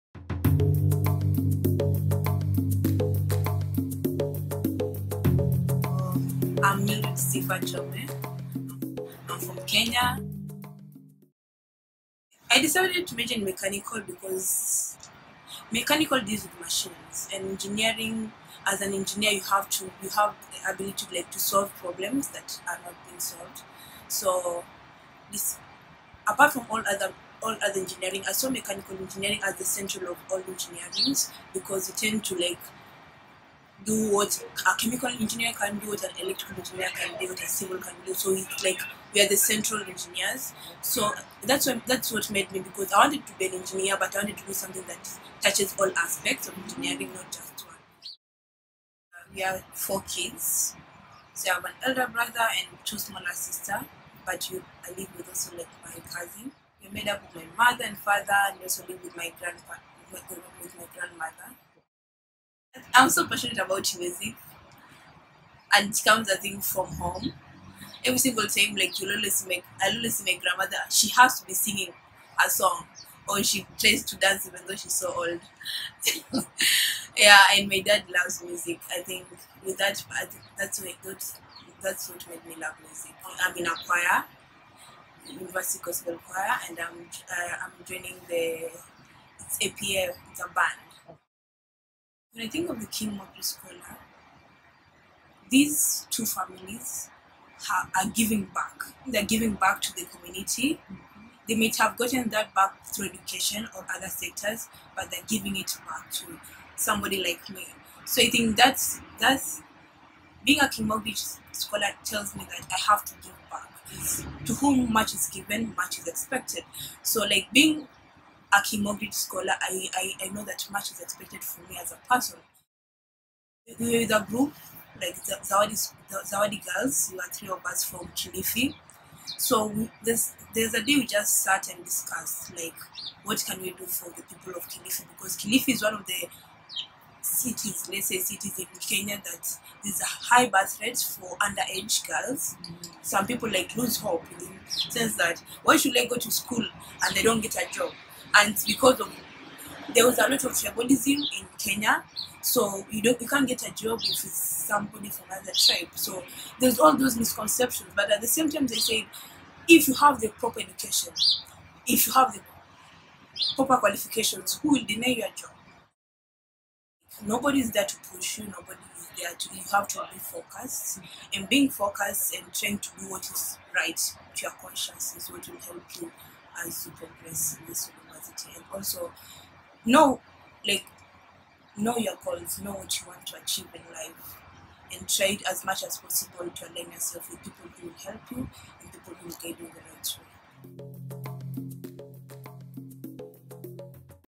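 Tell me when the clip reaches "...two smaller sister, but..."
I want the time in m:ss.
0:52.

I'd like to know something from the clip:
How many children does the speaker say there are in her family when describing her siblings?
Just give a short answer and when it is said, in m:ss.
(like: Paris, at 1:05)
4, at 0:49.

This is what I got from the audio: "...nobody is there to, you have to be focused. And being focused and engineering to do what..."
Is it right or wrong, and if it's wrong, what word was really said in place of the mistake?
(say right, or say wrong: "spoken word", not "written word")
wrong: "trying", not "engineering".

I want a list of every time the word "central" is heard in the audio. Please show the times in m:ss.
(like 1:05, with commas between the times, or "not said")
0:29, 0:39.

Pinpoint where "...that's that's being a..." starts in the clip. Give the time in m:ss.
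1:48.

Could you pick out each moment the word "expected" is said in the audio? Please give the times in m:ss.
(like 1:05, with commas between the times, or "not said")
1:56, 2:00.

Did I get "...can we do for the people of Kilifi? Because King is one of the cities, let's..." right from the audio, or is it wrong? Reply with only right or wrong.
wrong.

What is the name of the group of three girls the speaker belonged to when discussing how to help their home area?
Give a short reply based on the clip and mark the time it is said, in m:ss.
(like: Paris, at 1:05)
Zawadi girls, at 2:06.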